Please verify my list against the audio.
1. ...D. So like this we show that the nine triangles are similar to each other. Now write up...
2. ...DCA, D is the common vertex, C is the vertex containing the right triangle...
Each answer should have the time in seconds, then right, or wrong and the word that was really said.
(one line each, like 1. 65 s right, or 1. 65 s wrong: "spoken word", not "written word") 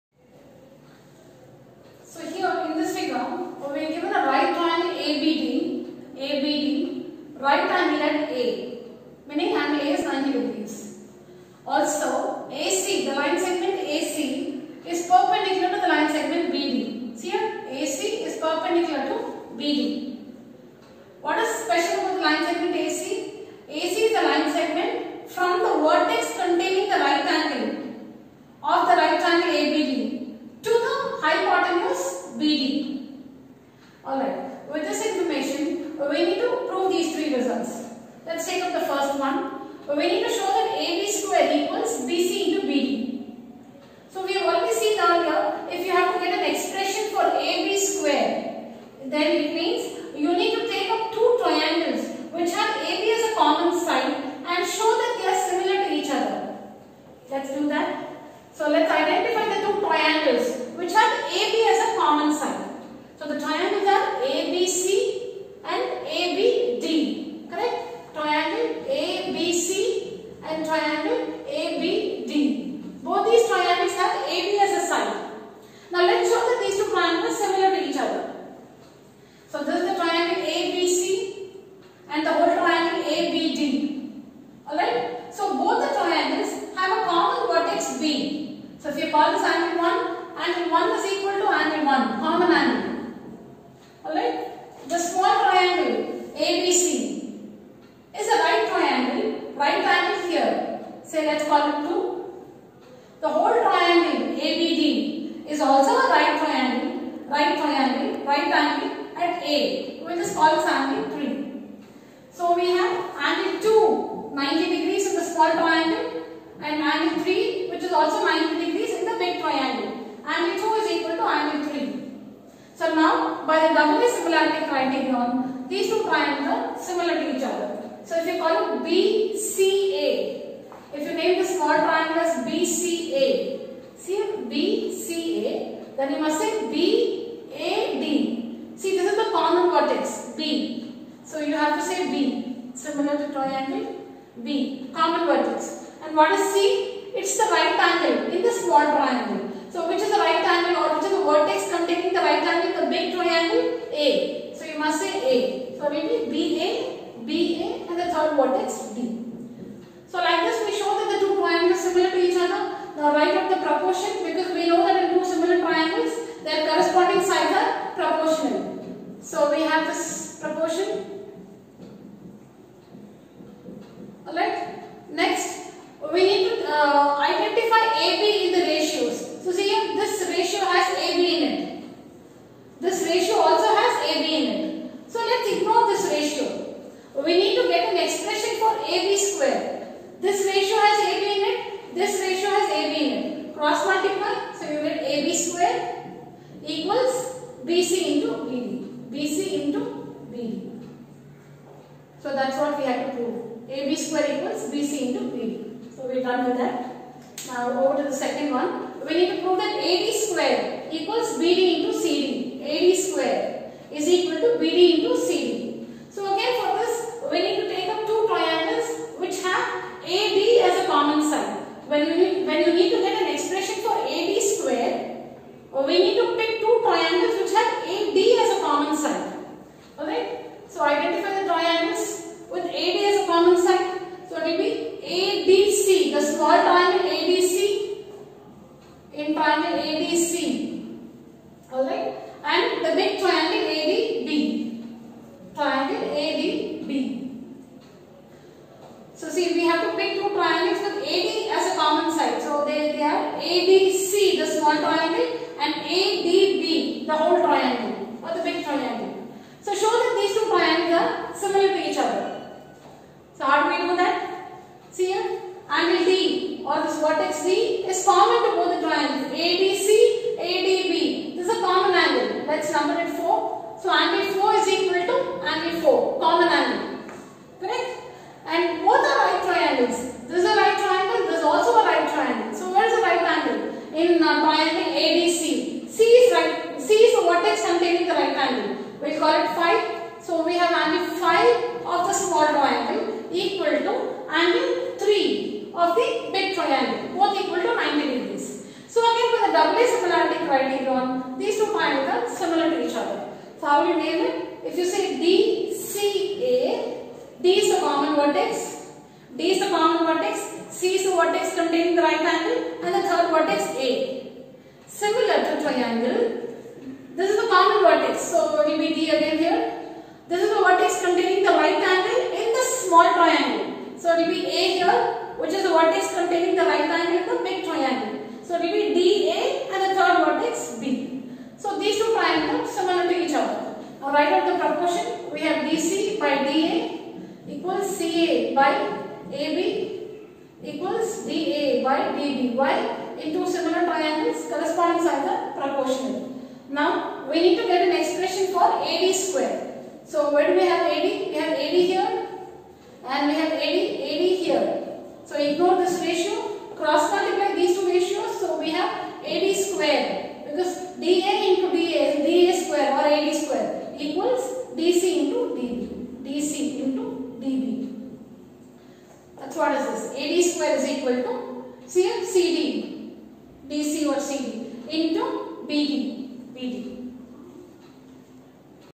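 1. 158 s wrong: "two", not "nine"
2. 305 s wrong: "angle", not "triangle".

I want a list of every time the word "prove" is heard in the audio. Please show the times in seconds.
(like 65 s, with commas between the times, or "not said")
203 s, 209 s.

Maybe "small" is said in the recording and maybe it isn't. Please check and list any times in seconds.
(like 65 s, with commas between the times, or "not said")
115 s, 148 s, 254 s, 292 s, 322 s.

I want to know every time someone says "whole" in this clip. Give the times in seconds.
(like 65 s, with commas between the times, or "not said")
257 s.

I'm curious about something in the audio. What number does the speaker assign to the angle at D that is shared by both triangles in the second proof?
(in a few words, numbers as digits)
4.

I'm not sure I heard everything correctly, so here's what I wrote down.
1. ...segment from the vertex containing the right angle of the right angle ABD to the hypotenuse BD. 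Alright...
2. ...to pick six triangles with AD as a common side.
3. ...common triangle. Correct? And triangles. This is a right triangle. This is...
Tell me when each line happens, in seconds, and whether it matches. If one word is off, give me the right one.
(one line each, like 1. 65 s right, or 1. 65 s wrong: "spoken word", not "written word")
1. 24 s right
2. 249 s wrong: "two", not "six"
3. 276 s wrong: "angle", not "triangle".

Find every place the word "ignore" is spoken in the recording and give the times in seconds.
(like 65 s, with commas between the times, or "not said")
185 s, 355 s.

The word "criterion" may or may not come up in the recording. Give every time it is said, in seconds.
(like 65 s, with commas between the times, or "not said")
124 s, 300 s.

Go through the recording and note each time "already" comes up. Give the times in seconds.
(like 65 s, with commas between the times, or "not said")
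44 s.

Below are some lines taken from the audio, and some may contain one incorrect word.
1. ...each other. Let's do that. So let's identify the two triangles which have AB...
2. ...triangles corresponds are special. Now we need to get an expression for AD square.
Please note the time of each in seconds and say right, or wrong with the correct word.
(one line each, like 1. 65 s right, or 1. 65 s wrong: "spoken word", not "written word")
1. 55 s right
2. 343 s wrong: "proportional", not "special".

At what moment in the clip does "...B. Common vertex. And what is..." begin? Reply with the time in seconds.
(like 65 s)
144 s.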